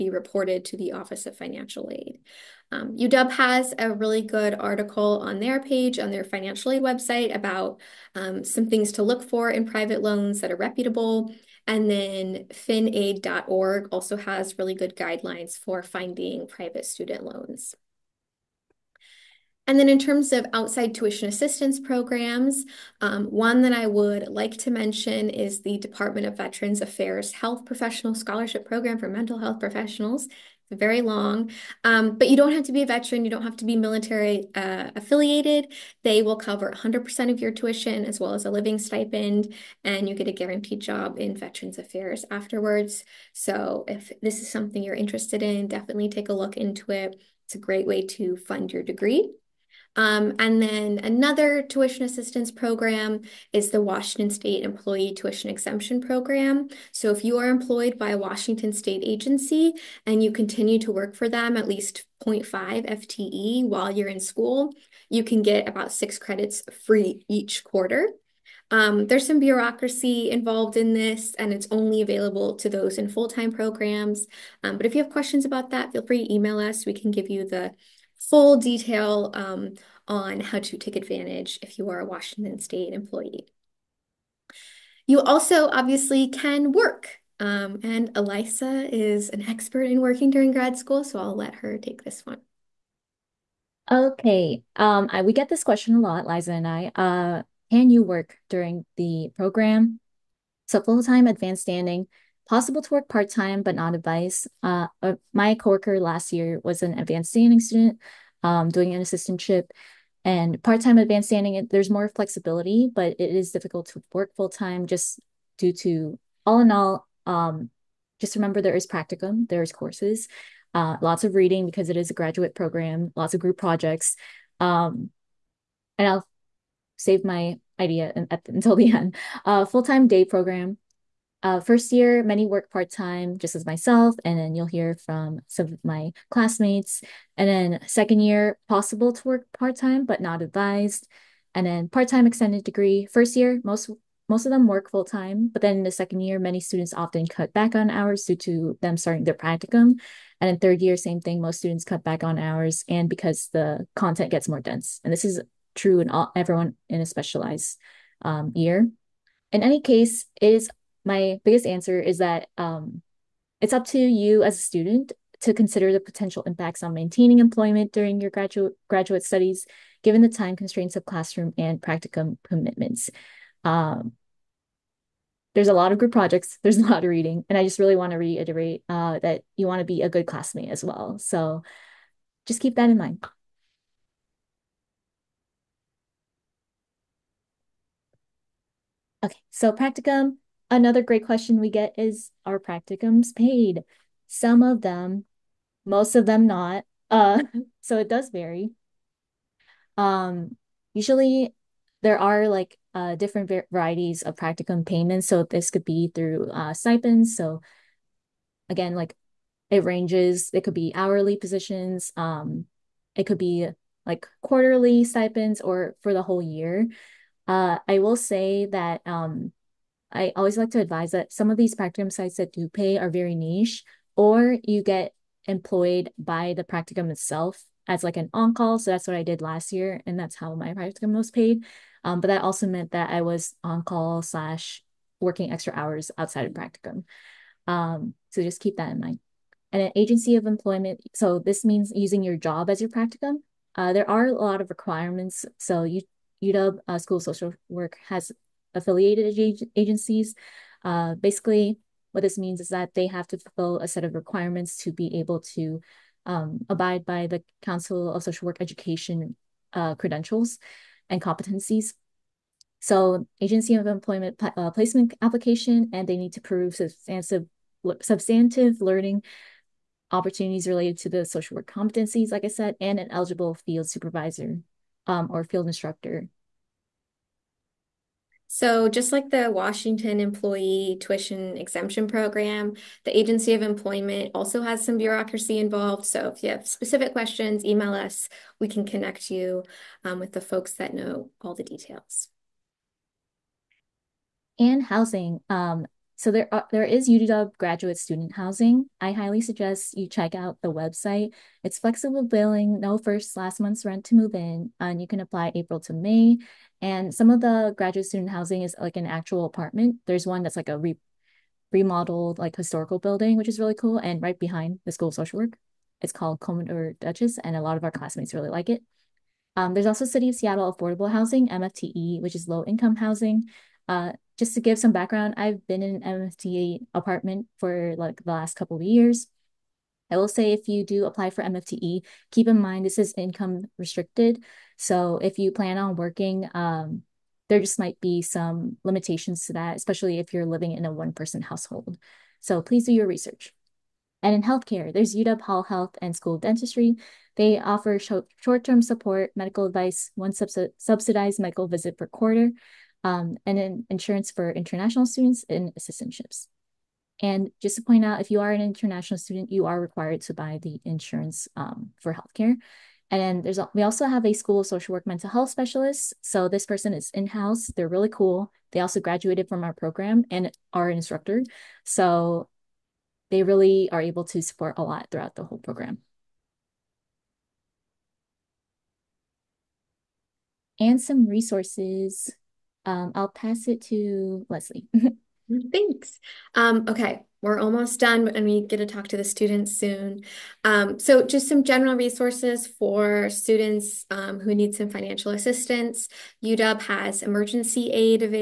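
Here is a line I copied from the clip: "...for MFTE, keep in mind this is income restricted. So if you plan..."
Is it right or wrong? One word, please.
right.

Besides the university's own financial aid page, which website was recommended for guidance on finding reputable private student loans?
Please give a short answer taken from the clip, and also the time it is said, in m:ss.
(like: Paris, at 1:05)
finaid.org, at 0:12.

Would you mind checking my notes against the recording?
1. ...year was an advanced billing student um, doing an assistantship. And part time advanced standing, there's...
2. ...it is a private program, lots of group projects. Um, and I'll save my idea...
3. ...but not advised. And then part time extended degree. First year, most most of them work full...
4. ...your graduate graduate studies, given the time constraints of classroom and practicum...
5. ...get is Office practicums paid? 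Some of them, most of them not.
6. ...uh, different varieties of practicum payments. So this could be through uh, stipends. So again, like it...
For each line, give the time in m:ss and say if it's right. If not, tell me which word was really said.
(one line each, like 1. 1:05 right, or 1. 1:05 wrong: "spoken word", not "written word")
1. 1:46 wrong: "standing", not "billing"
2. 2:01 wrong: "graduate", not "private"
3. 2:20 right
4. 2:48 right
5. 3:11 wrong: "Are", not "Office"
6. 3:22 right.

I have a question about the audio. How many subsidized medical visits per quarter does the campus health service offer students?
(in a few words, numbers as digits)
1.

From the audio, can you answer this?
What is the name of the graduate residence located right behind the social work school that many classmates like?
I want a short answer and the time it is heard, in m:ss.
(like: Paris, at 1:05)
Commodore Duchess, at 5:16.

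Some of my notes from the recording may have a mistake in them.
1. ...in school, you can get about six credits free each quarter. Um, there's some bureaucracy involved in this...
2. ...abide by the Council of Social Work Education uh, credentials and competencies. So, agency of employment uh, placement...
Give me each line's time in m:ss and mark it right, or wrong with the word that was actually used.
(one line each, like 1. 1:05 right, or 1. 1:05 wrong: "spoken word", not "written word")
1. 1:04 right
2. 4:16 right.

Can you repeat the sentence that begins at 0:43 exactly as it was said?
So if this is something you're interested in, definitely take a look into it.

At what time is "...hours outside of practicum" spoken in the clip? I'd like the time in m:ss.
3:55.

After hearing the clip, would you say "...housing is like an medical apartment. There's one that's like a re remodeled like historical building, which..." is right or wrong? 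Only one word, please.
wrong.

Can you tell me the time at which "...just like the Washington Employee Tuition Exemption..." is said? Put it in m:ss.
4:38.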